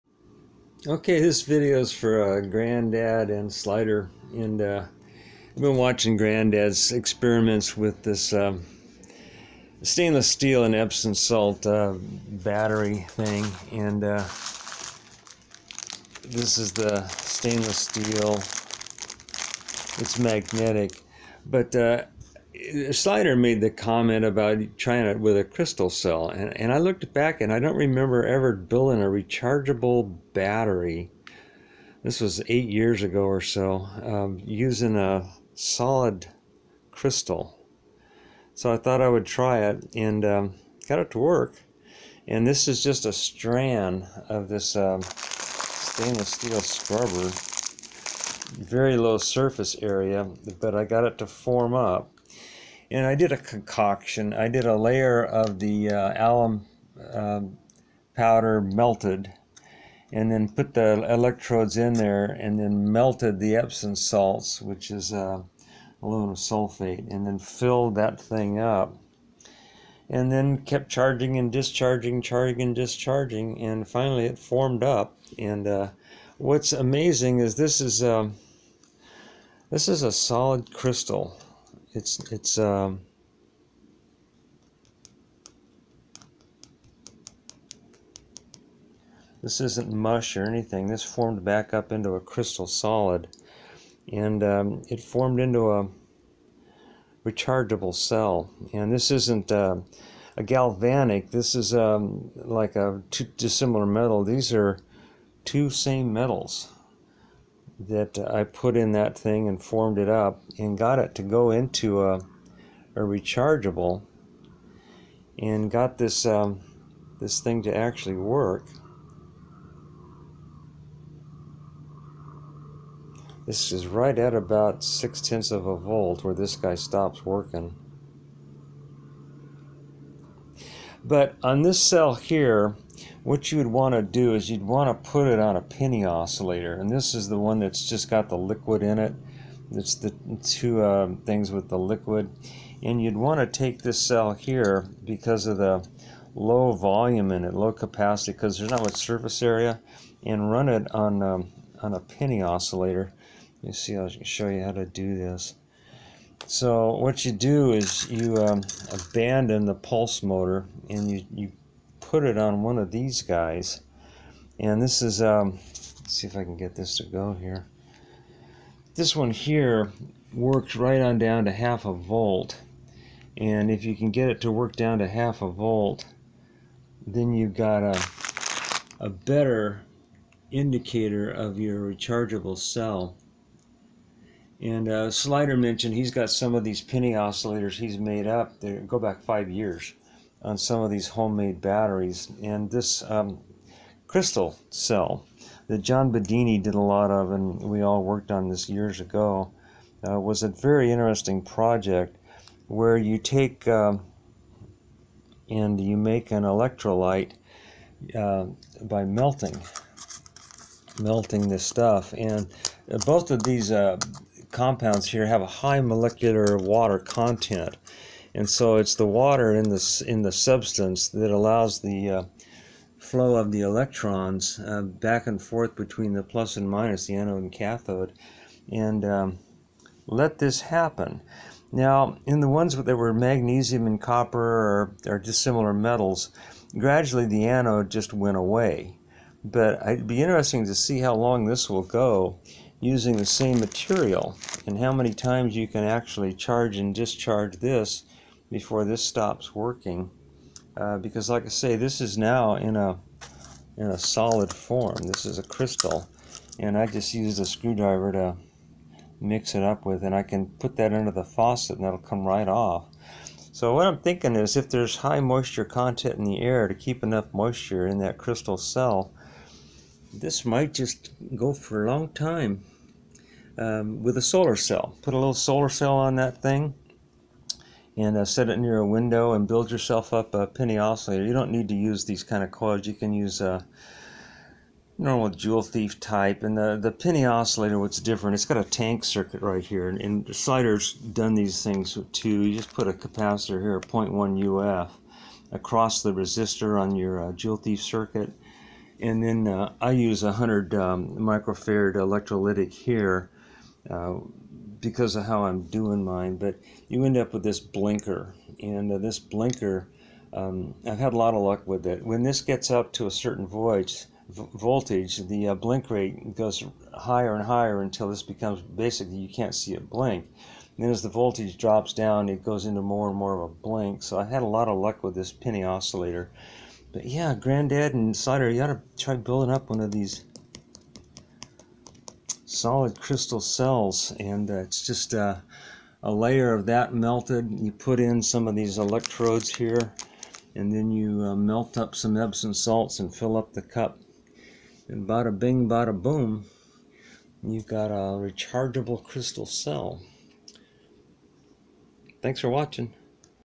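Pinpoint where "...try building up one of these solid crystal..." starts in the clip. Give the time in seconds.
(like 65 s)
328 s.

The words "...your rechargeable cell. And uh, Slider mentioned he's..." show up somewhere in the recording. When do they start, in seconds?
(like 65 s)
181 s.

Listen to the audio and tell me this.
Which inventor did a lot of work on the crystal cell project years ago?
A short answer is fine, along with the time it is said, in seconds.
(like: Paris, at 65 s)
John Bedini, at 195 s.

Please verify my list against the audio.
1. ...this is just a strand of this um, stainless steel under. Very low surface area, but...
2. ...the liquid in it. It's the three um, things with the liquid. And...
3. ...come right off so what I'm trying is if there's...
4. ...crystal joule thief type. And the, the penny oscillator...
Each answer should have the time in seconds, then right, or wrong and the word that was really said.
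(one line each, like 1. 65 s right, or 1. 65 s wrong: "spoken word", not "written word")
1. 42 s wrong: "scrubber", not "under"
2. 138 s wrong: "two", not "three"
3. 261 s wrong: "thinking", not "trying"
4. 284 s wrong: "normal", not "crystal".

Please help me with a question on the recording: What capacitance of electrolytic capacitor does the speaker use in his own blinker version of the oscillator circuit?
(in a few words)
100 microfarad.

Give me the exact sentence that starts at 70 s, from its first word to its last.
And then kept charging and discharging, charging and discharging, and finally it formed up.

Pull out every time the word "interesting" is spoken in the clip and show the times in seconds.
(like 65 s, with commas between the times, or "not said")
200 s, 240 s.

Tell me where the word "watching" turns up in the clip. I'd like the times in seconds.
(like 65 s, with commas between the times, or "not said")
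5 s, 352 s.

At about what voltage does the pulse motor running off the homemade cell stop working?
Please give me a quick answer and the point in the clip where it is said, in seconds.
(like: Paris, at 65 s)
0.6 volts, at 124 s.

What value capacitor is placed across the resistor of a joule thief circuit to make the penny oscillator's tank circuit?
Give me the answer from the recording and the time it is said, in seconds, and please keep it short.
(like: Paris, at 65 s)
0.1 uF, at 293 s.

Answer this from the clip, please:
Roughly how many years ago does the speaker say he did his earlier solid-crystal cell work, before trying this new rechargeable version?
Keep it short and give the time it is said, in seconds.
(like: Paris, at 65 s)
8 years, at 32 s.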